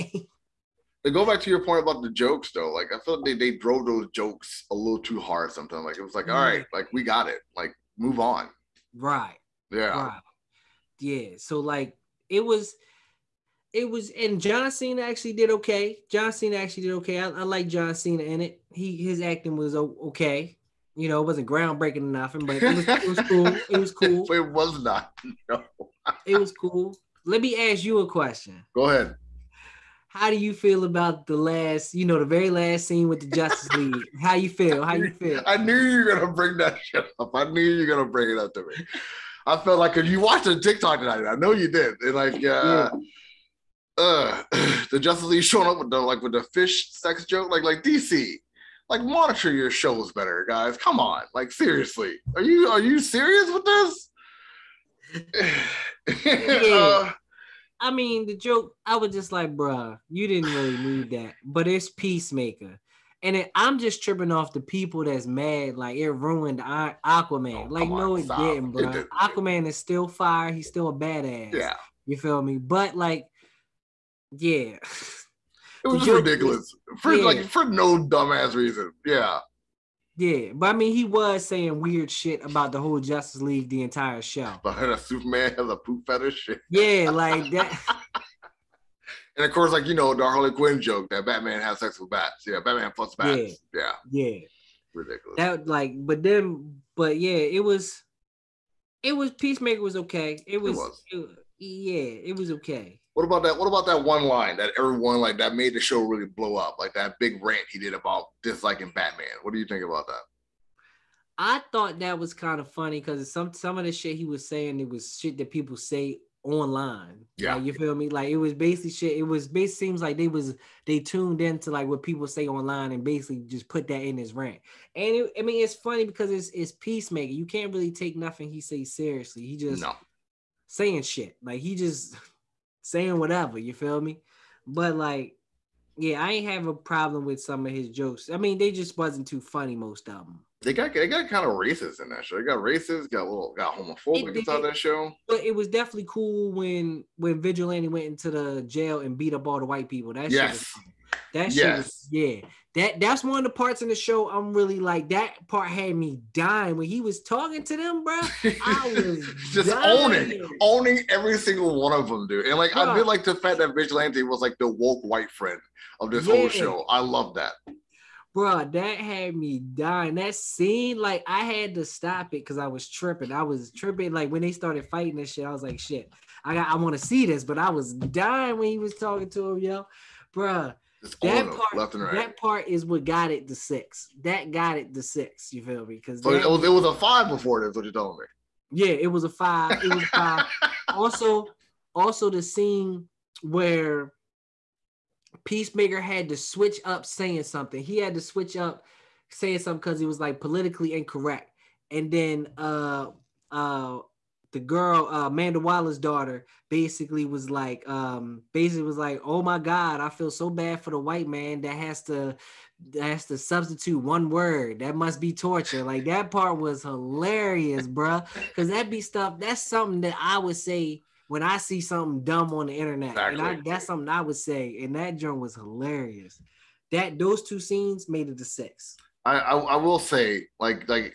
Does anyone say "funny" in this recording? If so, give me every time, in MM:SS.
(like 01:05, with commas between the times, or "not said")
01:52, 02:05, 02:19.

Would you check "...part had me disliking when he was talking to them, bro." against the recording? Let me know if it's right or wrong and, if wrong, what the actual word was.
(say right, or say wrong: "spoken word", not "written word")
wrong: "dying", not "disliking".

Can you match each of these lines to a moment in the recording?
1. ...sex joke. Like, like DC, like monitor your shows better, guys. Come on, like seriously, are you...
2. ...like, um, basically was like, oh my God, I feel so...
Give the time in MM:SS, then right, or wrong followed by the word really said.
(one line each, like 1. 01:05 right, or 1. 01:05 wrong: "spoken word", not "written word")
1. 00:46 right
2. 03:27 right.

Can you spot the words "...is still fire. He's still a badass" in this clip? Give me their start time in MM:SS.
01:09.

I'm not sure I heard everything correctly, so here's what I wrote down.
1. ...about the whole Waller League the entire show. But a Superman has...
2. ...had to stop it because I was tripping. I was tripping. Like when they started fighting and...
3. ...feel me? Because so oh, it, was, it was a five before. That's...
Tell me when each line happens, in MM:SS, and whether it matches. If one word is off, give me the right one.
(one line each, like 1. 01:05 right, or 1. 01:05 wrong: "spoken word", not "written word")
1. 01:22 wrong: "Justice", not "Waller"
2. 02:51 right
3. 03:05 right.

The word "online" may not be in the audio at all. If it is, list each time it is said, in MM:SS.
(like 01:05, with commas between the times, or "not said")
01:56, 02:02.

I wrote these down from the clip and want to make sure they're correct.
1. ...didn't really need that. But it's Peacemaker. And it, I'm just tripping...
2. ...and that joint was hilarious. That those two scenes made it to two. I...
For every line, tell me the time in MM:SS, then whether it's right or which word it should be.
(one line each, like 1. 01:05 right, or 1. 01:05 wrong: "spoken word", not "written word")
1. 01:00 right
2. 03:44 wrong: "six", not "two".